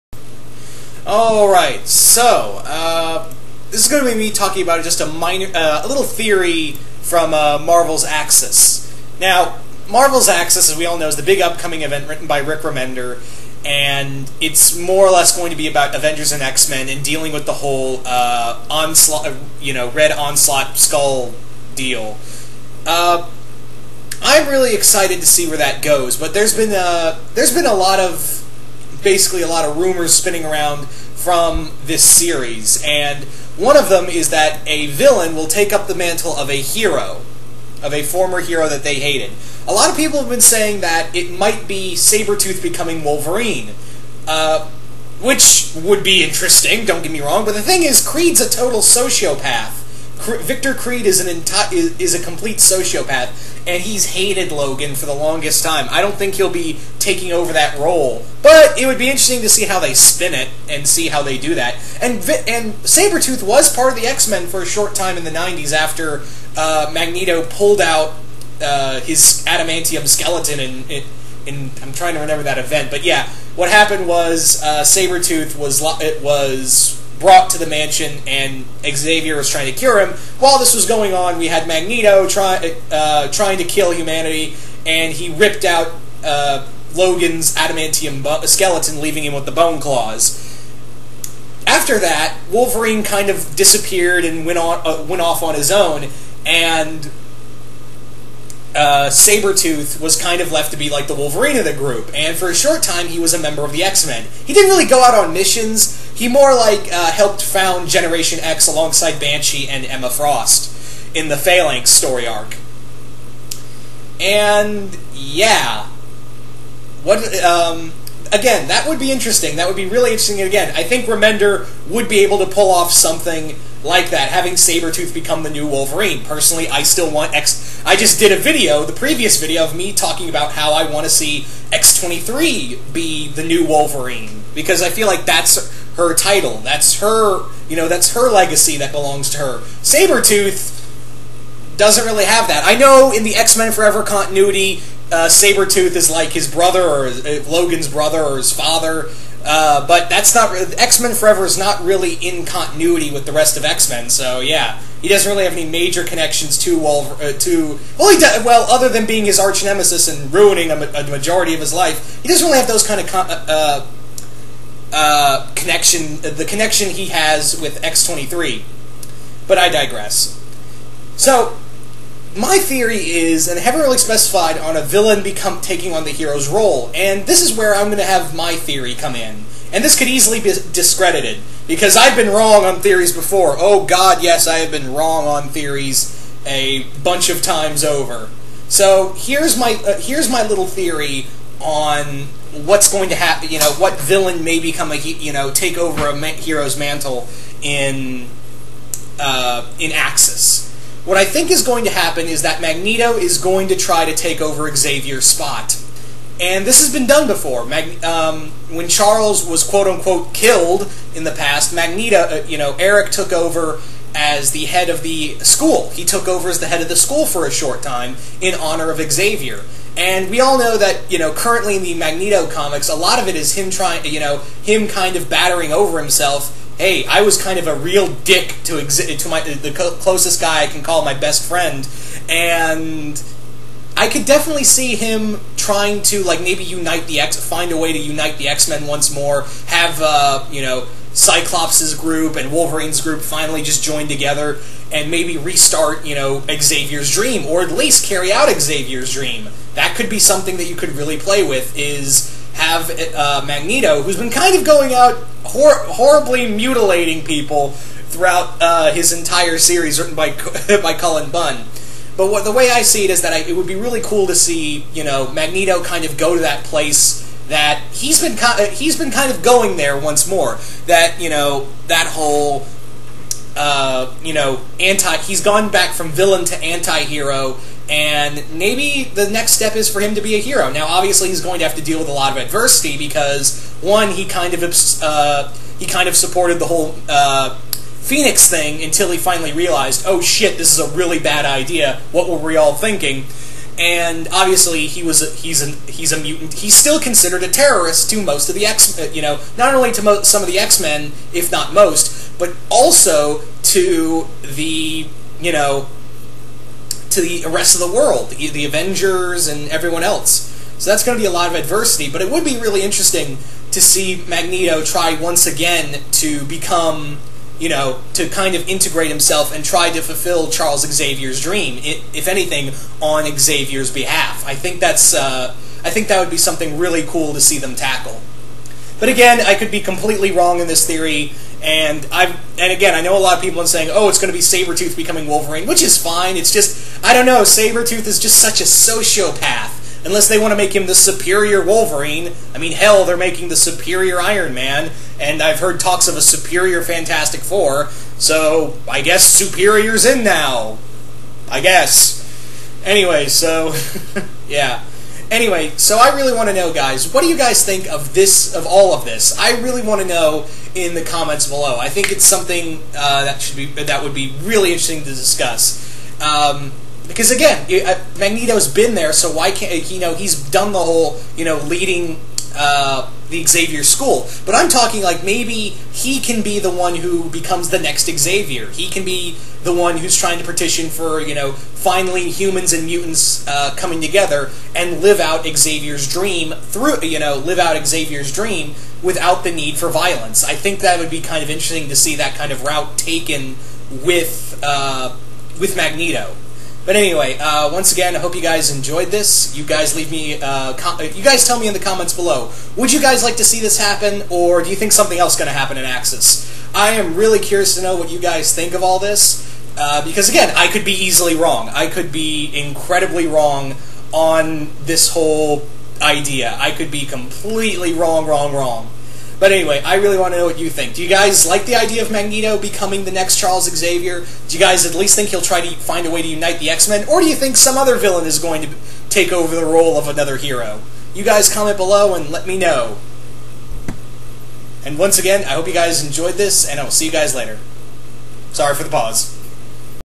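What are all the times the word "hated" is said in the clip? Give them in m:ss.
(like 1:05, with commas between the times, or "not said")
0:38, 0:54.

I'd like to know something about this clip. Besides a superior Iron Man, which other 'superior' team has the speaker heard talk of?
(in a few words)
Fantastic Four.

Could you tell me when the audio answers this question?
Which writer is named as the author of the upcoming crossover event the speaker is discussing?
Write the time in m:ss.
0:12.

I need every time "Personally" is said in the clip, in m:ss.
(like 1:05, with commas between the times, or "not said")
2:06.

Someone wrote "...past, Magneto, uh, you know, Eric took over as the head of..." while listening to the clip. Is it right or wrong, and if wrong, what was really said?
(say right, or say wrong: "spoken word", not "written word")
right.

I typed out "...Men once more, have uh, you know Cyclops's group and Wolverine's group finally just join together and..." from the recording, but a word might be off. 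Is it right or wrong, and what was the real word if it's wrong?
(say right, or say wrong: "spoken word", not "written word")
right.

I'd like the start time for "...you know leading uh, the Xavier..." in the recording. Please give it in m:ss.
6:11.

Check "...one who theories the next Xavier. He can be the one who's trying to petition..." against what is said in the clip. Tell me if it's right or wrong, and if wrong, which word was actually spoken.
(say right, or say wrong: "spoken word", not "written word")
wrong: "becomes", not "theories".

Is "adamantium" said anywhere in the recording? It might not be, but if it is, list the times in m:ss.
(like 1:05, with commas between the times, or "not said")
1:09, 1:27.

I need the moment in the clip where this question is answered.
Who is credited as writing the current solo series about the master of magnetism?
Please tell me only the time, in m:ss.
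4:20.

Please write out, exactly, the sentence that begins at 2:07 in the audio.
I just did a video, the previous video, of me talking about how I want to see X23 be the new Wolverine.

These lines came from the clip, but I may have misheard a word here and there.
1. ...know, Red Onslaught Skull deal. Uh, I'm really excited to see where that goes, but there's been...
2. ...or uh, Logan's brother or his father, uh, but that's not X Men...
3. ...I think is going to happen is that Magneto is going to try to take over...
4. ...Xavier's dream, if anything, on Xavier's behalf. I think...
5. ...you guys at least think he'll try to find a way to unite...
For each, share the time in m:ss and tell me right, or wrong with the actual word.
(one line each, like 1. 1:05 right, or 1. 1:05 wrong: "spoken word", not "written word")
1. 0:19 right
2. 2:26 right
3. 3:21 right
4. 5:20 right
5. 7:04 right.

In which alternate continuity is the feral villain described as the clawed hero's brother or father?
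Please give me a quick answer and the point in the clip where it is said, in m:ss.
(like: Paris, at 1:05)
X-Men Forever, at 2:23.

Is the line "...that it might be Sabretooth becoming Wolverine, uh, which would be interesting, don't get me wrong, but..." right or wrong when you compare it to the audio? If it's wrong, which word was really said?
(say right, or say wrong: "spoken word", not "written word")
right.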